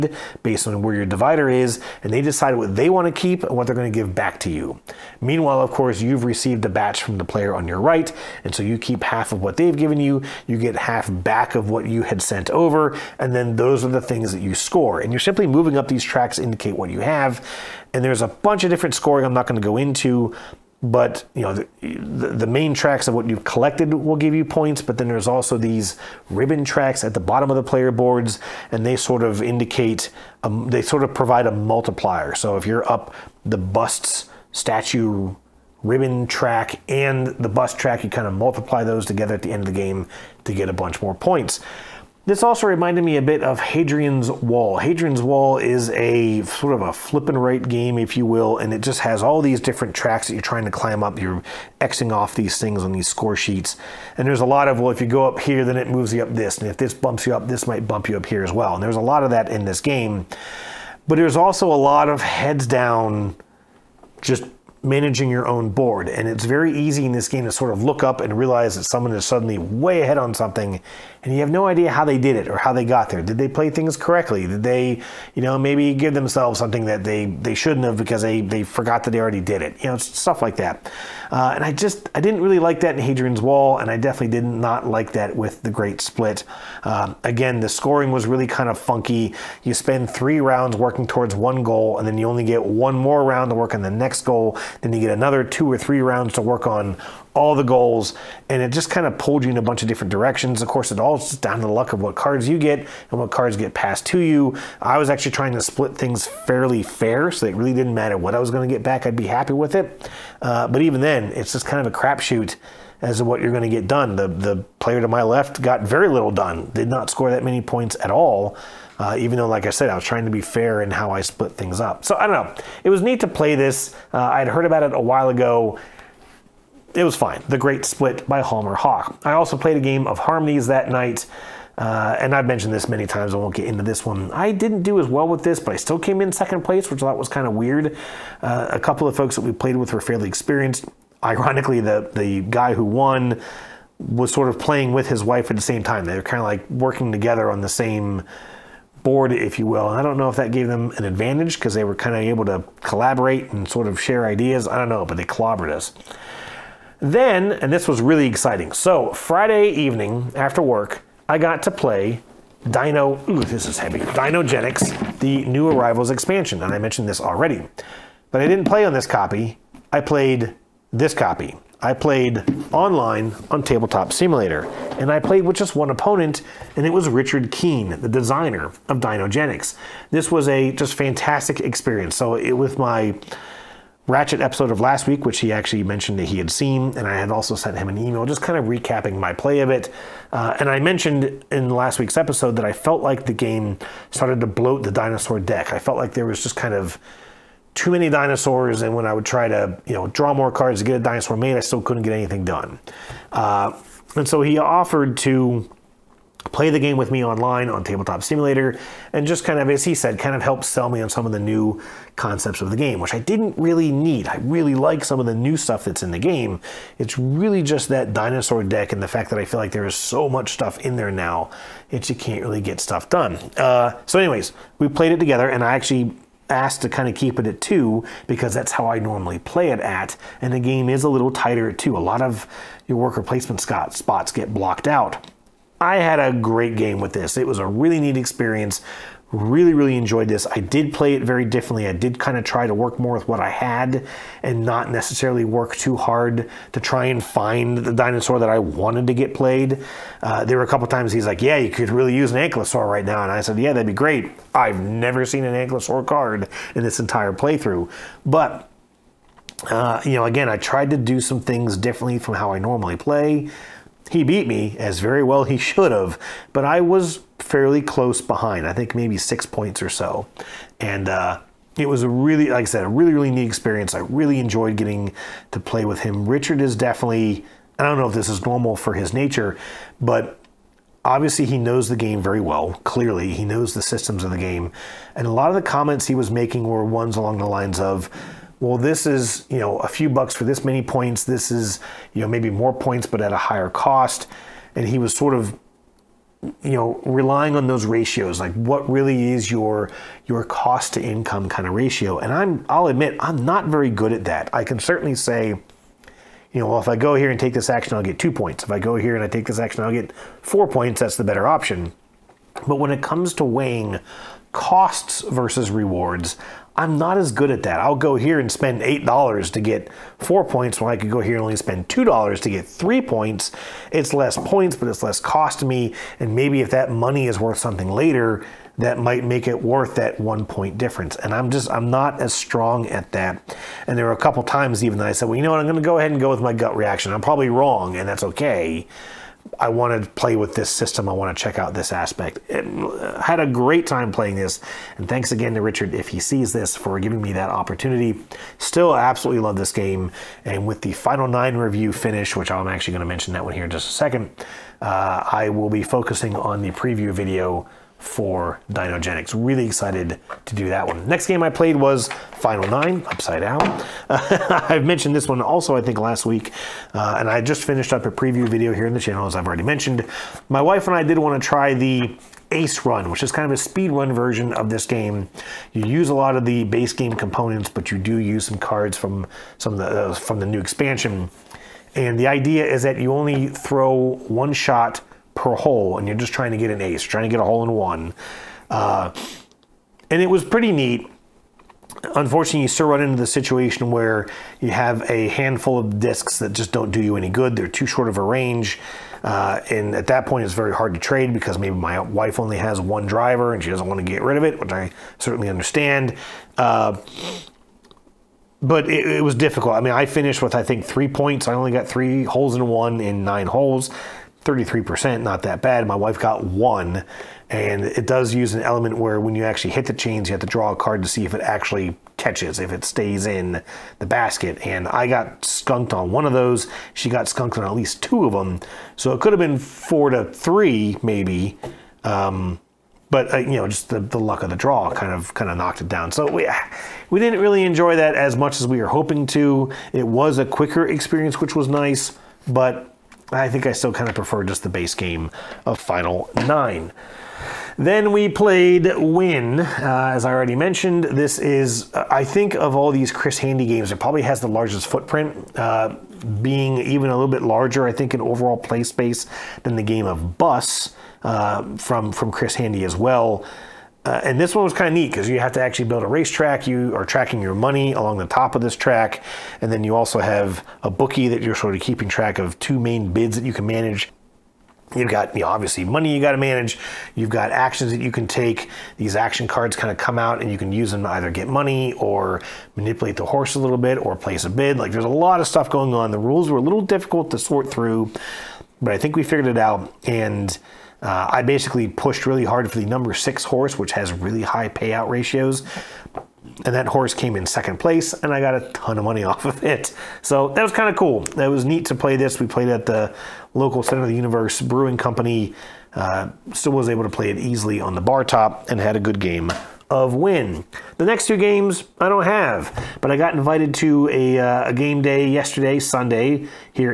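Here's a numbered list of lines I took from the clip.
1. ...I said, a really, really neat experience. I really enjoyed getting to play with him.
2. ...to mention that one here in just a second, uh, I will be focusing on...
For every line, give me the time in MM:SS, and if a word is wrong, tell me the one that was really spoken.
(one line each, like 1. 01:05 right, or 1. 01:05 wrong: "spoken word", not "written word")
1. 04:32 right
2. 05:53 right.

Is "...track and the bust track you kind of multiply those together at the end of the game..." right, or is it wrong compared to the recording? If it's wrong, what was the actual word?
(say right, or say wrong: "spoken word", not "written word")
right.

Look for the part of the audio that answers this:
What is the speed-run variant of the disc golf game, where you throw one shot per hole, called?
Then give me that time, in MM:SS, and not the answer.
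06:12.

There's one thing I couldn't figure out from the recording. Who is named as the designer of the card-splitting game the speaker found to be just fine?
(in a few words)
Hjalmar Hach.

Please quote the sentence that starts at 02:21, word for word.
Ironically, the, the guy who won was sort of playing with his wife at the same time.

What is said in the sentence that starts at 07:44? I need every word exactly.
Uh, and this one was kind of neat because you have to actually build a racetrack.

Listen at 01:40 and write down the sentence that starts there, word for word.
Of course, it all just down to the luck of what cards you get and what cards get passed to you.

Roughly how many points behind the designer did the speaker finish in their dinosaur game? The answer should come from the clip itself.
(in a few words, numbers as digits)
6.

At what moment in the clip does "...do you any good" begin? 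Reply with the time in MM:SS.
06:36.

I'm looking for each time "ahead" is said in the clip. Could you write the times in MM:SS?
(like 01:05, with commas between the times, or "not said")
01:10, 05:35.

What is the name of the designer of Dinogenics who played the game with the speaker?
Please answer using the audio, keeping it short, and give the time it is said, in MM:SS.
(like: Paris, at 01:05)
Richard Keene, at 02:57.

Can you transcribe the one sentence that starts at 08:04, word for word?
Like there's a lot of stuff going on.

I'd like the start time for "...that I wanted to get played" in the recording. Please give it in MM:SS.
04:08.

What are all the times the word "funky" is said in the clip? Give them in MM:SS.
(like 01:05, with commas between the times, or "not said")
01:28.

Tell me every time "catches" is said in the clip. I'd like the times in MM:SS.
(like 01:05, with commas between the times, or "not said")
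07:02.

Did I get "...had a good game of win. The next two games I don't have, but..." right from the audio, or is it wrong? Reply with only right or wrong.
right.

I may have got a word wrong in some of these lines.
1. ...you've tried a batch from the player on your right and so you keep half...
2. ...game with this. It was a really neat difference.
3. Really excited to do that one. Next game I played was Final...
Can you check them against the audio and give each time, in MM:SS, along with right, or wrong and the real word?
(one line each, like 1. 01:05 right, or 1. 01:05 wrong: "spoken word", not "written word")
1. 00:06 wrong: "received", not "tried"
2. 03:56 wrong: "experience", not "difference"
3. 05:59 right.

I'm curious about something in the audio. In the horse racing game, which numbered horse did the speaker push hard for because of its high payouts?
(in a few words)
6.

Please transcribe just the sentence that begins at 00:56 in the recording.
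And if this bumps you up, this might bump you up here as well.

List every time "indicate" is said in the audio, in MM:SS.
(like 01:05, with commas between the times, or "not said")
00:16, 00:29.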